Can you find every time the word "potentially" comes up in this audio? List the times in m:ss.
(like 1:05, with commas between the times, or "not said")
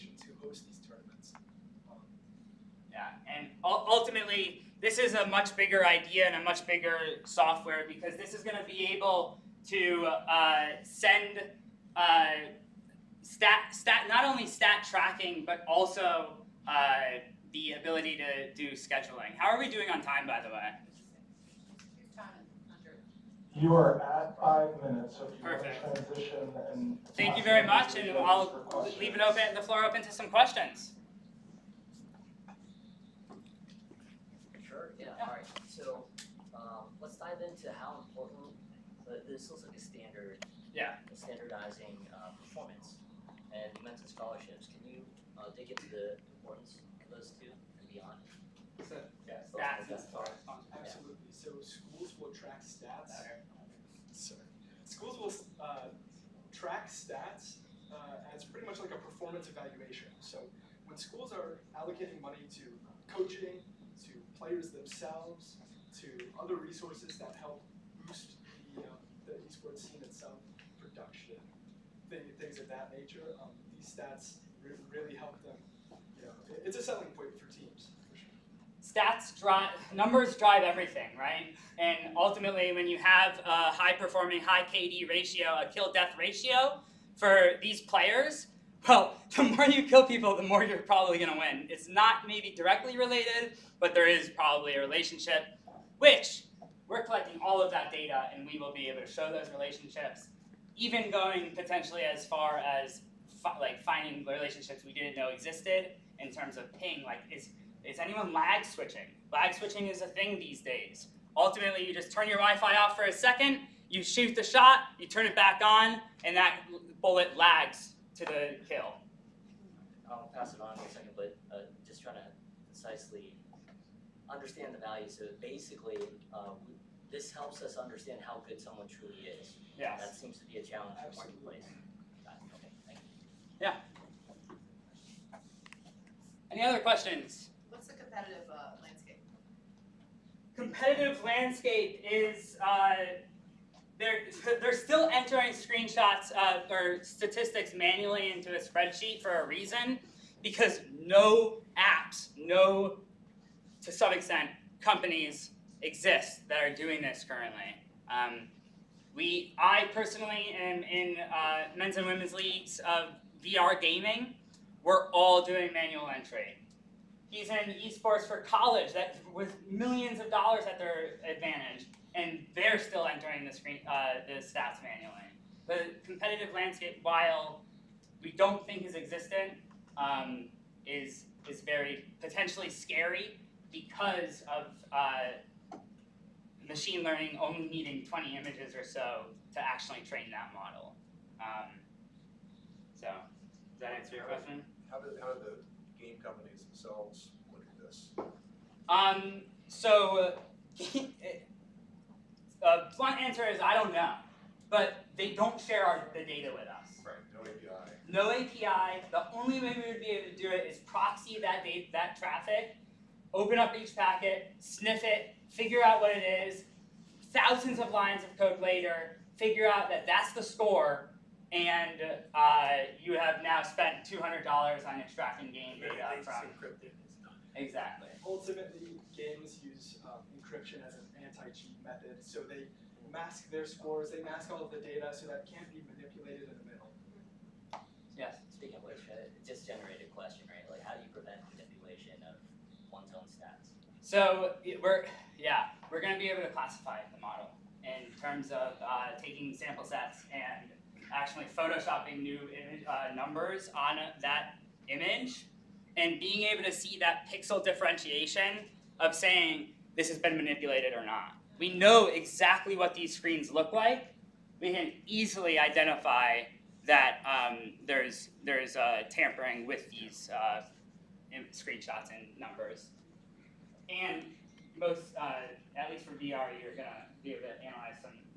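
1:41, 3:02.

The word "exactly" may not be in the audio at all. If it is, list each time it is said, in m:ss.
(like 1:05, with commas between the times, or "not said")
3:47, 4:22.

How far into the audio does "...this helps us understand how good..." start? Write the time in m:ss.
2:07.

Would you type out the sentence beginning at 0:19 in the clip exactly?
How are we doing on time, by the way?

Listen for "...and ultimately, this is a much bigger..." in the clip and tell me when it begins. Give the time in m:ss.
0:03.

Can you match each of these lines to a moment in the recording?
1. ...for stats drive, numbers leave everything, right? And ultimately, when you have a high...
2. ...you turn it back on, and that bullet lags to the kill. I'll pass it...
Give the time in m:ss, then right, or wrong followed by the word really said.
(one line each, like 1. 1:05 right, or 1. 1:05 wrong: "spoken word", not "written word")
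1. 1:17 wrong: "drive", not "leave"
2. 1:54 right.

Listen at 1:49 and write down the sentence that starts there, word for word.
Lag switching is a thing these days.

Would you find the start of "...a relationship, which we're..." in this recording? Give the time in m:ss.
1:34.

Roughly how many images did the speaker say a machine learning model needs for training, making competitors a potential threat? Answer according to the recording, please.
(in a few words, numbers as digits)
20.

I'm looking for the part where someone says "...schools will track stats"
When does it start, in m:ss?
0:51.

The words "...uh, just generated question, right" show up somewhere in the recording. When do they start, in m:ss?
3:59.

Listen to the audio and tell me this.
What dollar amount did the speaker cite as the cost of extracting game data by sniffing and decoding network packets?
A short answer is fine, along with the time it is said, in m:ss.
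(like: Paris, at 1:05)
$200, at 3:44.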